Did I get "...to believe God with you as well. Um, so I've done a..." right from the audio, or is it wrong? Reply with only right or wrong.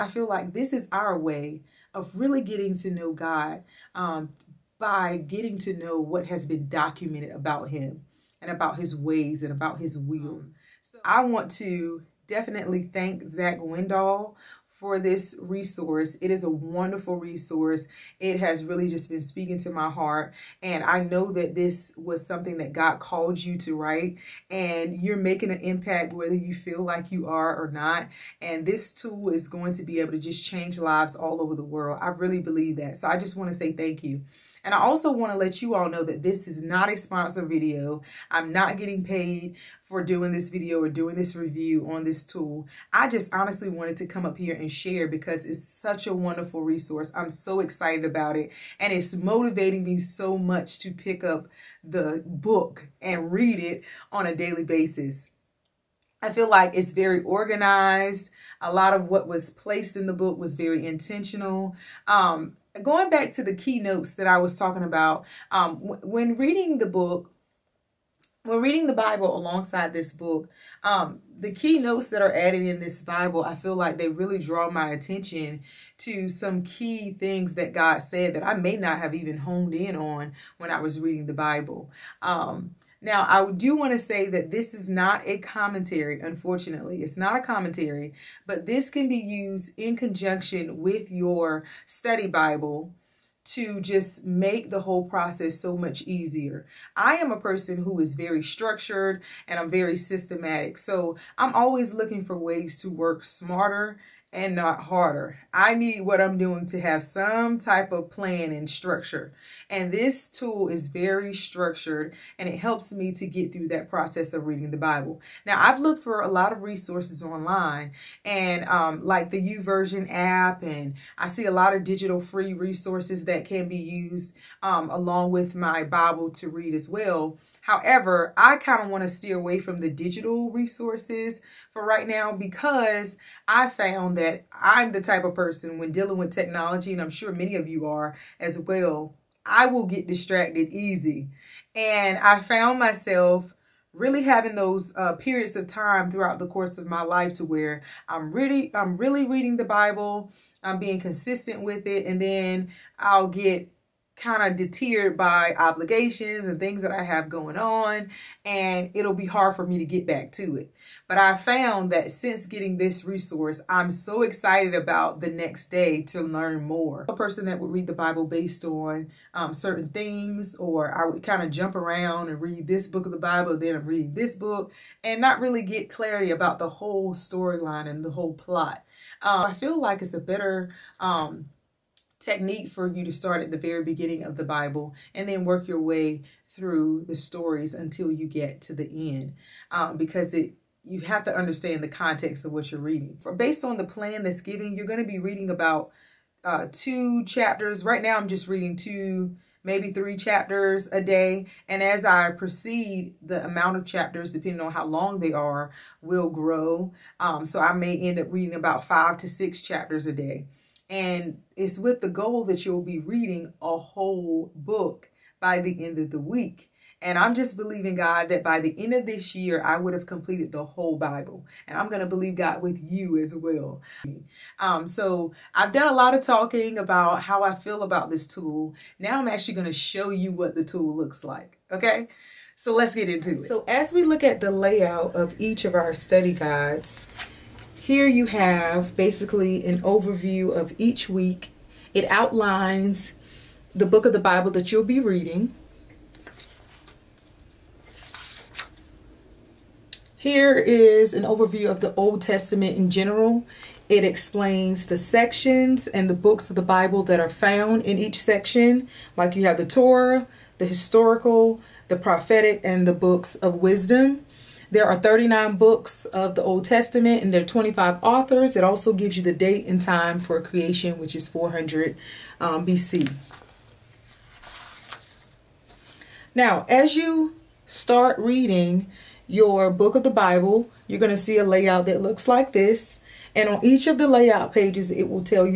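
right.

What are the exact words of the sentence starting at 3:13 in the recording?
For, based on the plan that's given, you're going to be reading about uh, two chapters.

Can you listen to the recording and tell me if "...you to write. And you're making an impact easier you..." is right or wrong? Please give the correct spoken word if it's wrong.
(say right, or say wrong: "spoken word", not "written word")
wrong: "whether", not "easier".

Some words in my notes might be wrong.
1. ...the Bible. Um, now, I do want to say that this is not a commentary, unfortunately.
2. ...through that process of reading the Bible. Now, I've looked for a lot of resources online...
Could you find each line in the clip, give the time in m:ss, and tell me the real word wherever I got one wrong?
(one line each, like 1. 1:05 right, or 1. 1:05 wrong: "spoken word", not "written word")
1. 1:21 right
2. 1:53 right.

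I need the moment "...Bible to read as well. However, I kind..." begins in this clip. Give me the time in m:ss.
2:05.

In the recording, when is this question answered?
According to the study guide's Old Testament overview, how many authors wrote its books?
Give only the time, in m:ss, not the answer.
4:27.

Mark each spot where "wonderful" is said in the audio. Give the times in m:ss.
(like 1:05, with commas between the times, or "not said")
0:16, 0:46.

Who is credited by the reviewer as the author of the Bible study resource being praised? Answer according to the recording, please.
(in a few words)
Zach Windahl.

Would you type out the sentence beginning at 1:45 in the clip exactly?
I need what I'm doing to have some type of plan and structure.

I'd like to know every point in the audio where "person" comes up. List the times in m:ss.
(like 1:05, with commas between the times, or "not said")
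1:37, 2:15, 2:47.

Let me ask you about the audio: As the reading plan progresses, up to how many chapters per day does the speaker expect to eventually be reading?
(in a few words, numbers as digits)
5 to 6.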